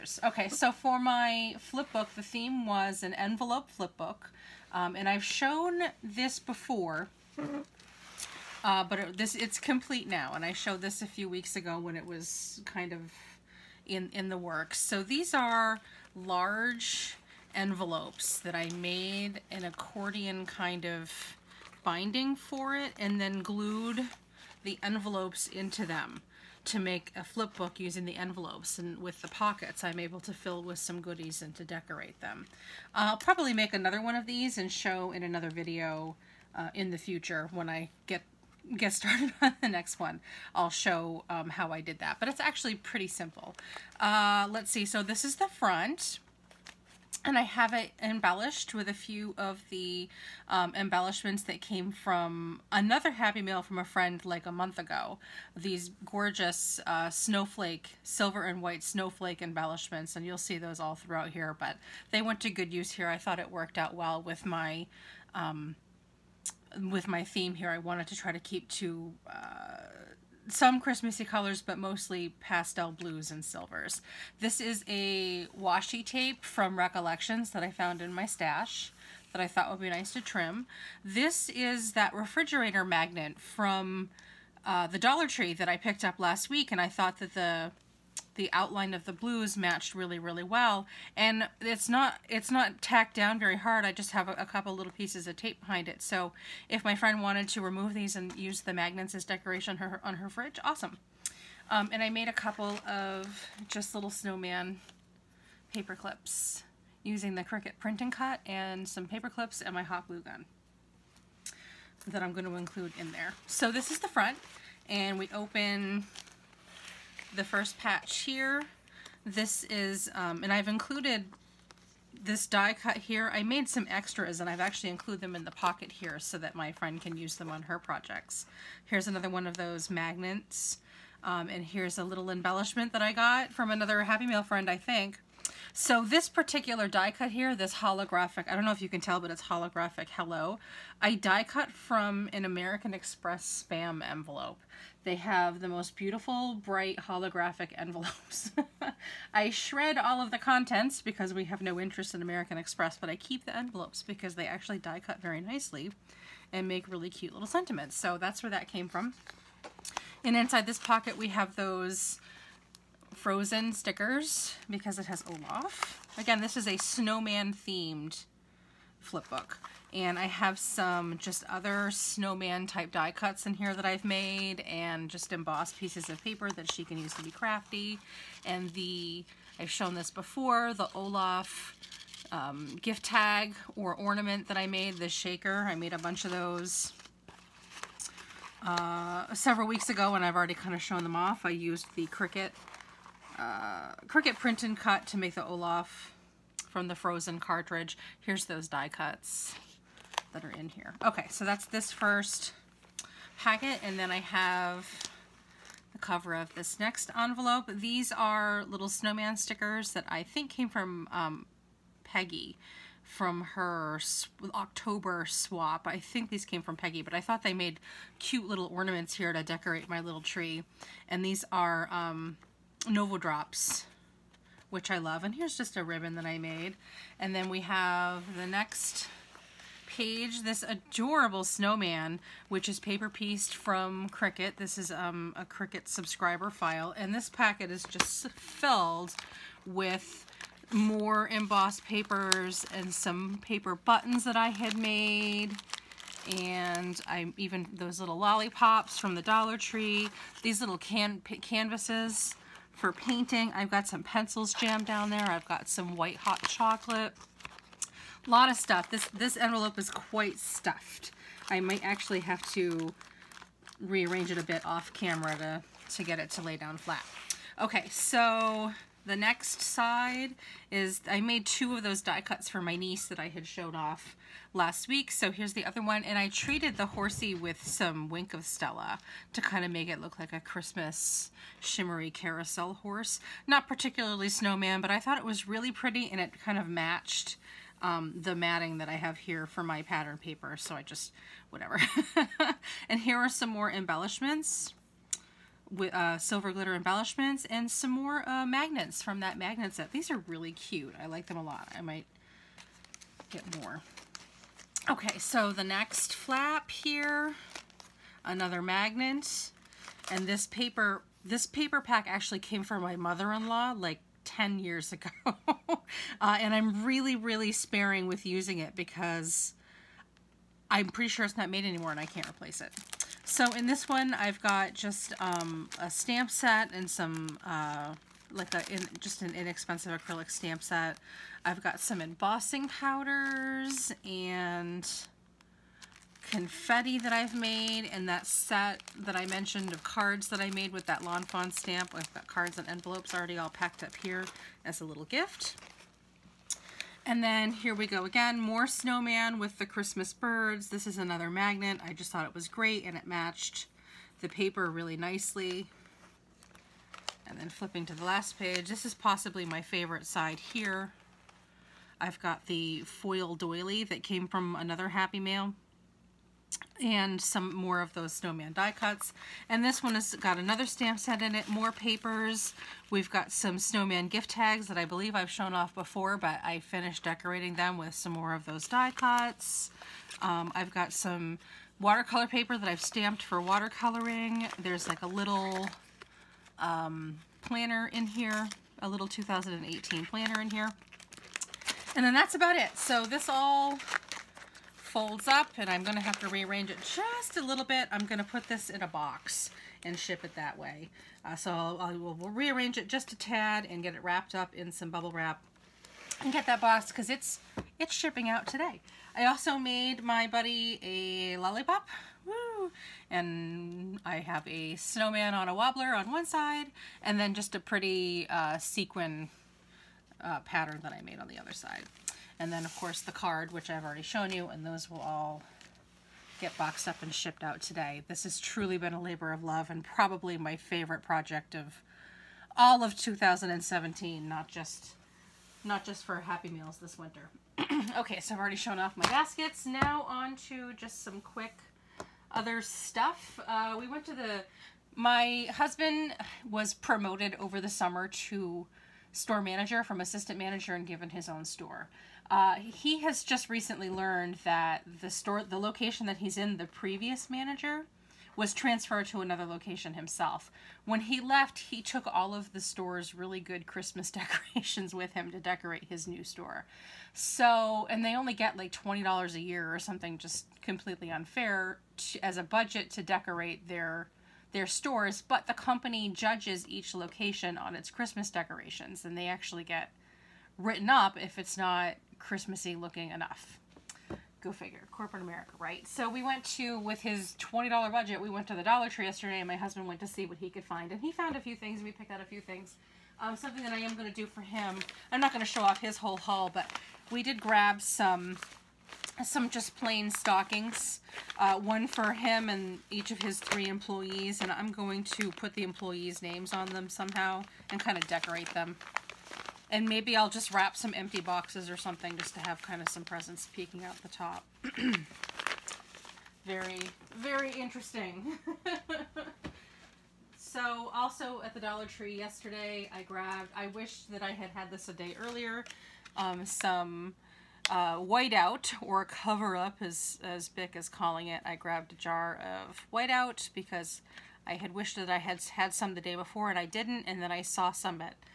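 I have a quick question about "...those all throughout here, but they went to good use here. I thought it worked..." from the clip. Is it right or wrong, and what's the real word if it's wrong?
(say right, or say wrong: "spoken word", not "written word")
right.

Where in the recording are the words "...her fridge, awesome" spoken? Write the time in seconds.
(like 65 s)
100 s.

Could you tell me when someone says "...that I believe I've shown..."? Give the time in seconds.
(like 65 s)
374 s.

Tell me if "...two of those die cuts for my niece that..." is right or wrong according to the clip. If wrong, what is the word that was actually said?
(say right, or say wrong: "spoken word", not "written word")
right.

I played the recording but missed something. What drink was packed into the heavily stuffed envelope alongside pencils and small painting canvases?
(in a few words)
white hot chocolate.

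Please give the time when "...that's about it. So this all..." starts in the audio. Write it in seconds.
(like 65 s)
392 s.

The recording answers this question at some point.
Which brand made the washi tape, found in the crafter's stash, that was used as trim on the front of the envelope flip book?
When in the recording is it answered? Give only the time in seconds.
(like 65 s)
76 s.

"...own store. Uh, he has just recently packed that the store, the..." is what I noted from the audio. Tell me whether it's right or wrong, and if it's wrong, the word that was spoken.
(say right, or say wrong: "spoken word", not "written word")
wrong: "learned", not "packed".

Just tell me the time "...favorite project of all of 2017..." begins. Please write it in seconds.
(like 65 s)
430 s.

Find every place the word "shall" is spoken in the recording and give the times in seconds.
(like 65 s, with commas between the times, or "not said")
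not said.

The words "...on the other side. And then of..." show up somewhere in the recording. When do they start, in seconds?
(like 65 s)
421 s.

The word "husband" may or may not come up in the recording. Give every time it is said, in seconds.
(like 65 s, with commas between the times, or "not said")
445 s, 489 s.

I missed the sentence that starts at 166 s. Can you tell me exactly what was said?
Again, this is a snowman themed flip book.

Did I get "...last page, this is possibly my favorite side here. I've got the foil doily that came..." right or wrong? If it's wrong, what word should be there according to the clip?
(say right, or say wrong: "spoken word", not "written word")
right.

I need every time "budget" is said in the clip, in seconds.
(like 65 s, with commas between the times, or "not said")
472 s, 487 s.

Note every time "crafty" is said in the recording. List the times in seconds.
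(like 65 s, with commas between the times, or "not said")
177 s.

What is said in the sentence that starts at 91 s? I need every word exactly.
And it's not it's not tacked down very hard.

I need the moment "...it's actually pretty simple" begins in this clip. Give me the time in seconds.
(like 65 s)
42 s.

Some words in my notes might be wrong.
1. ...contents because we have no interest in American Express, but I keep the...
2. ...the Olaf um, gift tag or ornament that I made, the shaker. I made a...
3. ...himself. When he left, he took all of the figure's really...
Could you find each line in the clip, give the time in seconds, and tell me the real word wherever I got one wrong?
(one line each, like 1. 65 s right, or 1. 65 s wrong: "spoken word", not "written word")
1. 150 s right
2. 180 s right
3. 459 s wrong: "store", not "figure".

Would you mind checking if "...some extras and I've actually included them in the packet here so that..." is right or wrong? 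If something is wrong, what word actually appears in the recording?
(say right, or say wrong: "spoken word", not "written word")
wrong: "pocket", not "packet".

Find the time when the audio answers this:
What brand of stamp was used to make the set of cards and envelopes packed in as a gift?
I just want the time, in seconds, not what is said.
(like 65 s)
341 s.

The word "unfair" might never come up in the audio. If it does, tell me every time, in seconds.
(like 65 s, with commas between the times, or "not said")
471 s.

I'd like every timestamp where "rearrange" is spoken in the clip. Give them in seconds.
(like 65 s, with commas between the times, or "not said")
263 s, 396 s, 402 s.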